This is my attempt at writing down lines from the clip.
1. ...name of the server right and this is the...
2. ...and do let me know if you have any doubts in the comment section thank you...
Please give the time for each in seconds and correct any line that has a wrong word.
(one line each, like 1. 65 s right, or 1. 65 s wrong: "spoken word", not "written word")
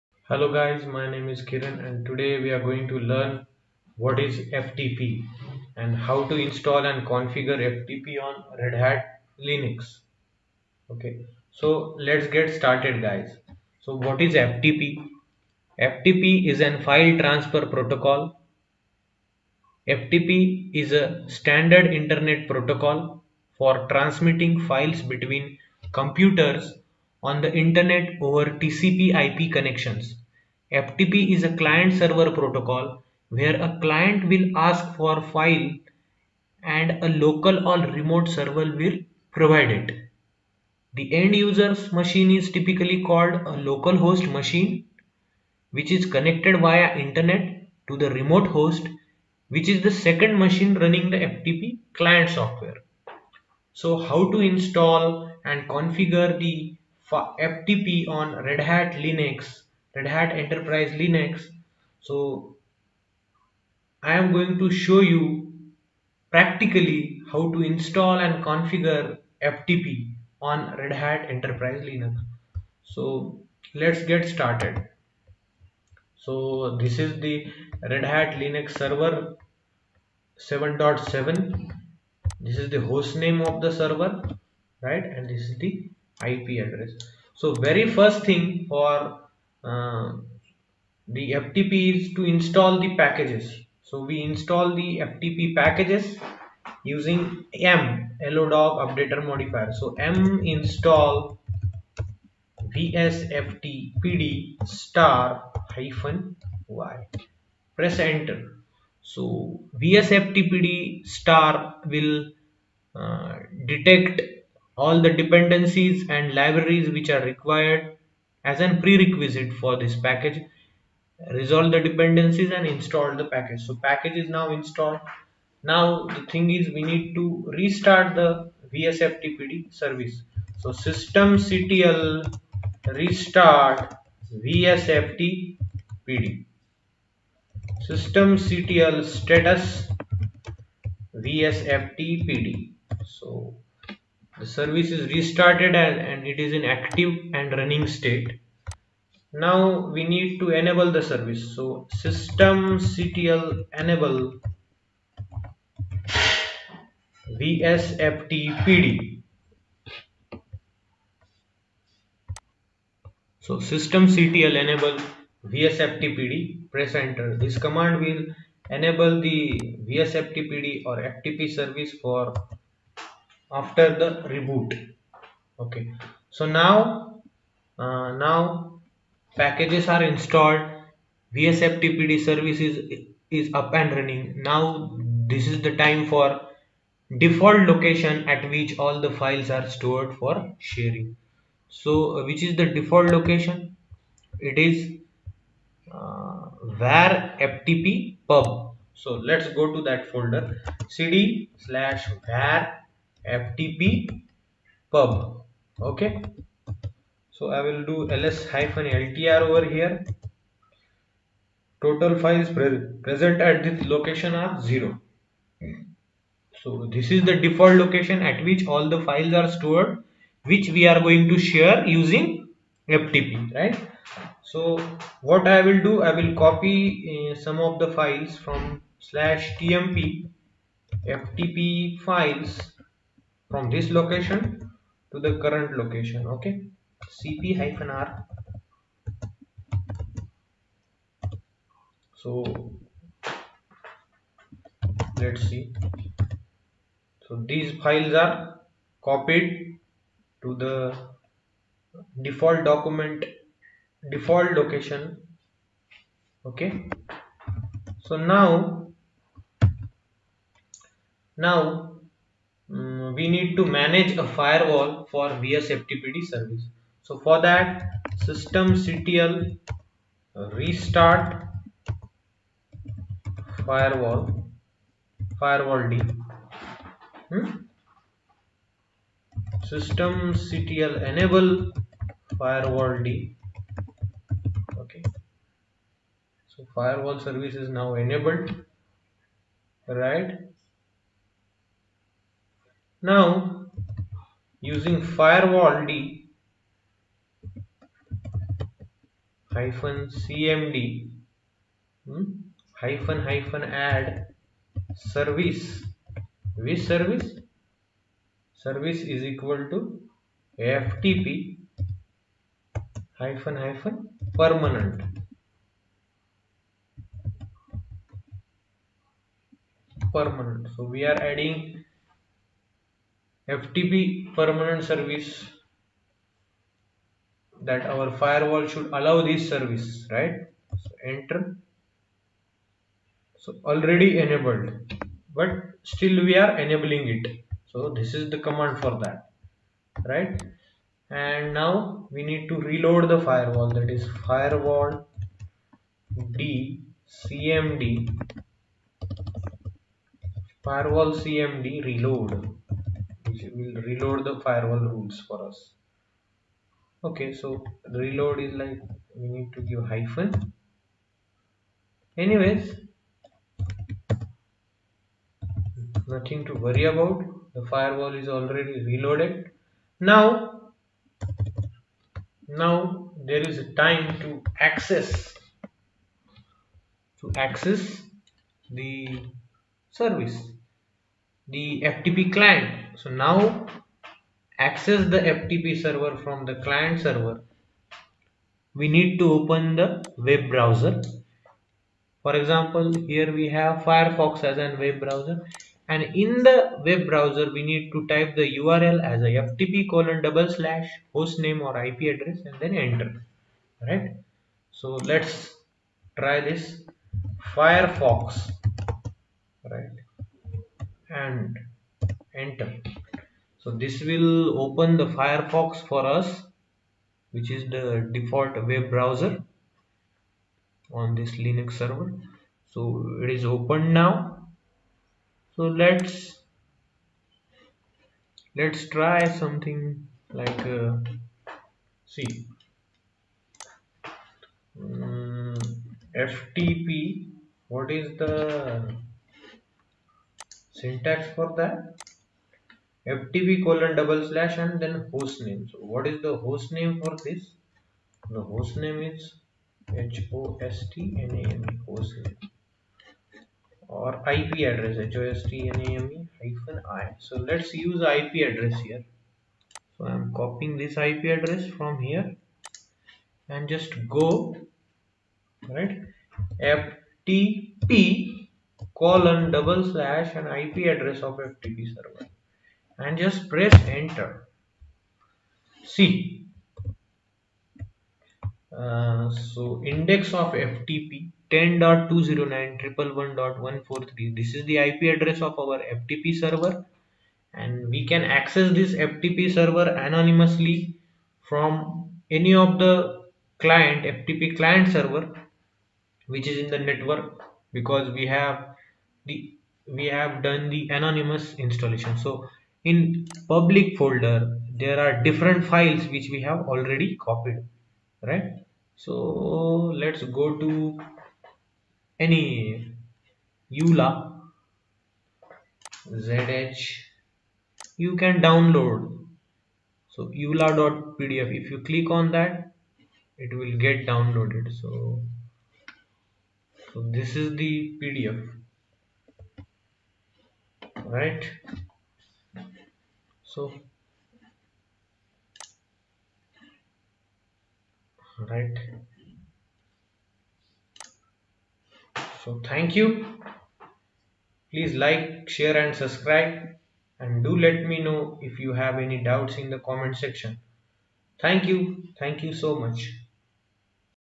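1. 83 s right
2. 547 s right.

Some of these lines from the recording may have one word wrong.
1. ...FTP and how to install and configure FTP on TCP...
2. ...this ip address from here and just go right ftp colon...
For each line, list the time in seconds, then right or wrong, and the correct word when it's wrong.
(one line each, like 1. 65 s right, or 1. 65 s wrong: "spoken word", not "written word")
1. 4 s wrong: "Red", not "TCP"
2. 460 s right.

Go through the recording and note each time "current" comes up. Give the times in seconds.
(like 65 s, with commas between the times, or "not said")
235 s.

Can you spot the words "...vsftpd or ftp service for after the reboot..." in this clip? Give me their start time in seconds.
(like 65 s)
169 s.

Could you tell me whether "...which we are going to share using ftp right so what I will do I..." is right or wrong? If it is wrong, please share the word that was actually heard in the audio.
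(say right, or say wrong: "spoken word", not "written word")
right.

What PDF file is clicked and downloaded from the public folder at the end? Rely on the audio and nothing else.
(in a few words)
eula.pdf.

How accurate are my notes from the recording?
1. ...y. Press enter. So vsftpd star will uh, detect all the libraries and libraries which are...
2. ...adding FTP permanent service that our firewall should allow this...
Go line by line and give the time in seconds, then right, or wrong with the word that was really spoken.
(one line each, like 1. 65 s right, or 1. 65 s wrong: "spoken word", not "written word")
1. 106 s wrong: "dependencies", not "libraries"
2. 321 s right.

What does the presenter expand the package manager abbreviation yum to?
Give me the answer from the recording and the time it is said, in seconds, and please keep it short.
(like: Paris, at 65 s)
Yellowdog updater modifier, at 98 s.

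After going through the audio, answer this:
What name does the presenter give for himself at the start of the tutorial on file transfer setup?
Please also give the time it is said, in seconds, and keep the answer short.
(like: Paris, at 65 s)
Kiran, at 1 s.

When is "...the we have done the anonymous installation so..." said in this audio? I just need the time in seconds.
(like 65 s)
499 s.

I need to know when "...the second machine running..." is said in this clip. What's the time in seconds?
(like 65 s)
49 s.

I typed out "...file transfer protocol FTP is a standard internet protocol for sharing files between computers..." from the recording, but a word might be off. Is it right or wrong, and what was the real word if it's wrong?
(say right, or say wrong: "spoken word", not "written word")
wrong: "transmitting", not "sharing".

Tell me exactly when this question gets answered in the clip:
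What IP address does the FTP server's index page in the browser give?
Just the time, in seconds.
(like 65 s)
481 s.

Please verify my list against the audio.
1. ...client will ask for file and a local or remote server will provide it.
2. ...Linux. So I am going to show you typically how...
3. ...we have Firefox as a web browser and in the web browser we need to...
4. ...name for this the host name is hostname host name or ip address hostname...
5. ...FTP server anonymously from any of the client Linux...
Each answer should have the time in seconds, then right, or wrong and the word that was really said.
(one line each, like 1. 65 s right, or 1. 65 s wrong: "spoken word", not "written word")
1. 33 s right
2. 60 s wrong: "practically", not "typically"
3. 393 s right
4. 446 s right
5. 488 s wrong: "FTP", not "Linux".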